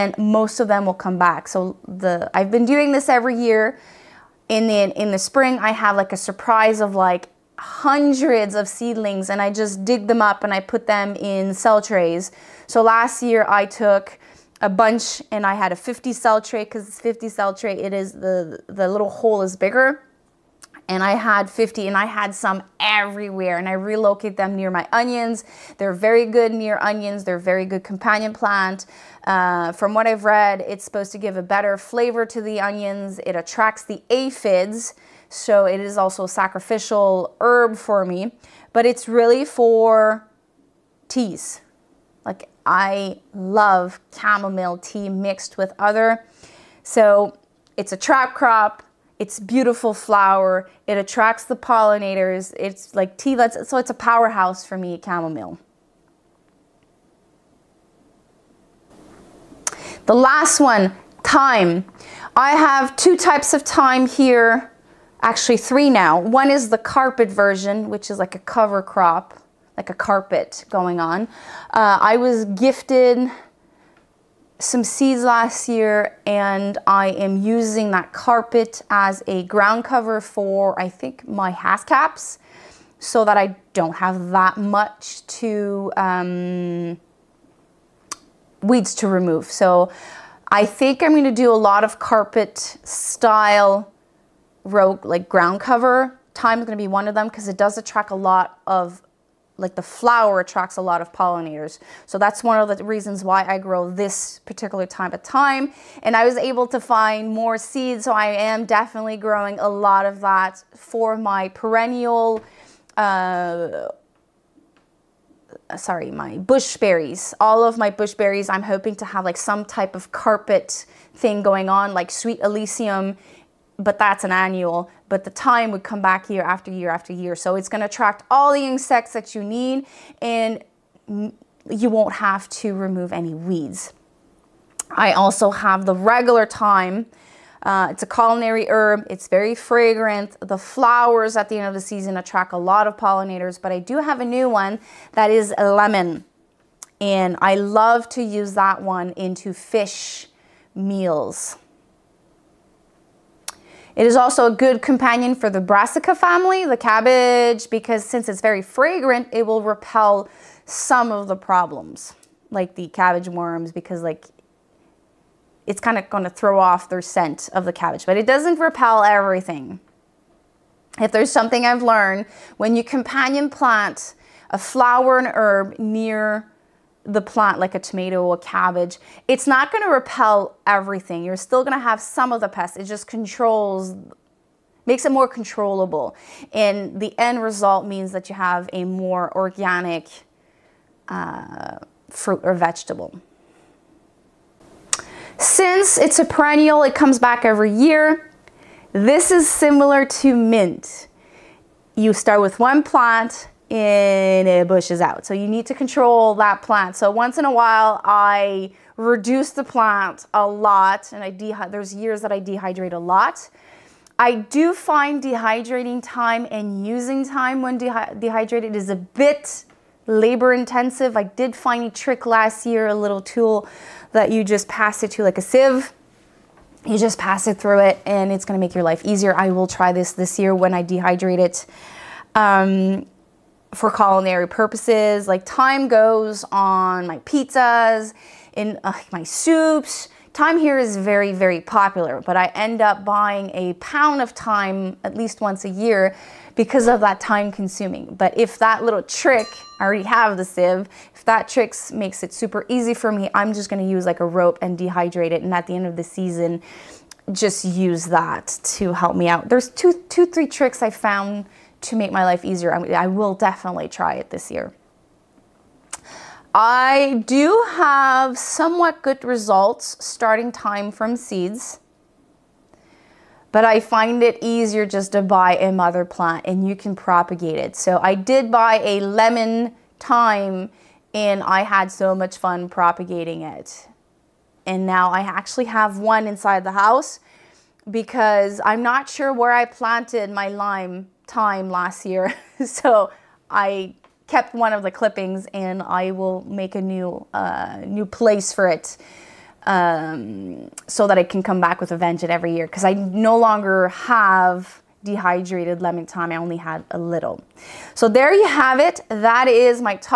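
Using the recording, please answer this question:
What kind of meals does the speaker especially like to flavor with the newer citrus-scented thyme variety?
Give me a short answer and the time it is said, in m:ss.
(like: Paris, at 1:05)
Fish meals, at 2:29.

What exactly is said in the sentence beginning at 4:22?
I will definitely try it this year.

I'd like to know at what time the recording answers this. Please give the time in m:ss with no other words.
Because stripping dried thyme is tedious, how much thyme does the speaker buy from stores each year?
4:03.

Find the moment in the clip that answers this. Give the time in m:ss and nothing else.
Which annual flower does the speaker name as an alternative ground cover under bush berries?
2:02.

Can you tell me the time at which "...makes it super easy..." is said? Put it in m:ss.
4:11.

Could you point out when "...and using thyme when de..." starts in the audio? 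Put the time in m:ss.
3:36.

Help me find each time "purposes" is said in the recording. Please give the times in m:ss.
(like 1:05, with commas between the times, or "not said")
3:54.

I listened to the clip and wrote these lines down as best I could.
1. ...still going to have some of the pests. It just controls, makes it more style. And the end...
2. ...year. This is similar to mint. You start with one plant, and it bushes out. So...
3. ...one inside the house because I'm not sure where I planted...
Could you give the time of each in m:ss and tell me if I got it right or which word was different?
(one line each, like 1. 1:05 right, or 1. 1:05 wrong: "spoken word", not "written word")
1. 3:01 wrong: "controllable", not "style"
2. 3:17 right
3. 4:45 right.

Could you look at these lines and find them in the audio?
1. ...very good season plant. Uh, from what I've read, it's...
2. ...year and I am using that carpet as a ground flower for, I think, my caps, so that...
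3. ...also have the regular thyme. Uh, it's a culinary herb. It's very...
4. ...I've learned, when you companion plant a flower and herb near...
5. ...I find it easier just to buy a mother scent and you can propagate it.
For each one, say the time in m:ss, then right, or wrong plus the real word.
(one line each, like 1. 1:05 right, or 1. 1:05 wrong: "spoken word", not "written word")
1. 0:27 wrong: "companion", not "season"
2. 1:15 wrong: "cover", not "flower"
3. 2:15 right
4. 2:51 right
5. 4:33 wrong: "plant", not "scent".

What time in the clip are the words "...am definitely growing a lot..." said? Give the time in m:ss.
1:48.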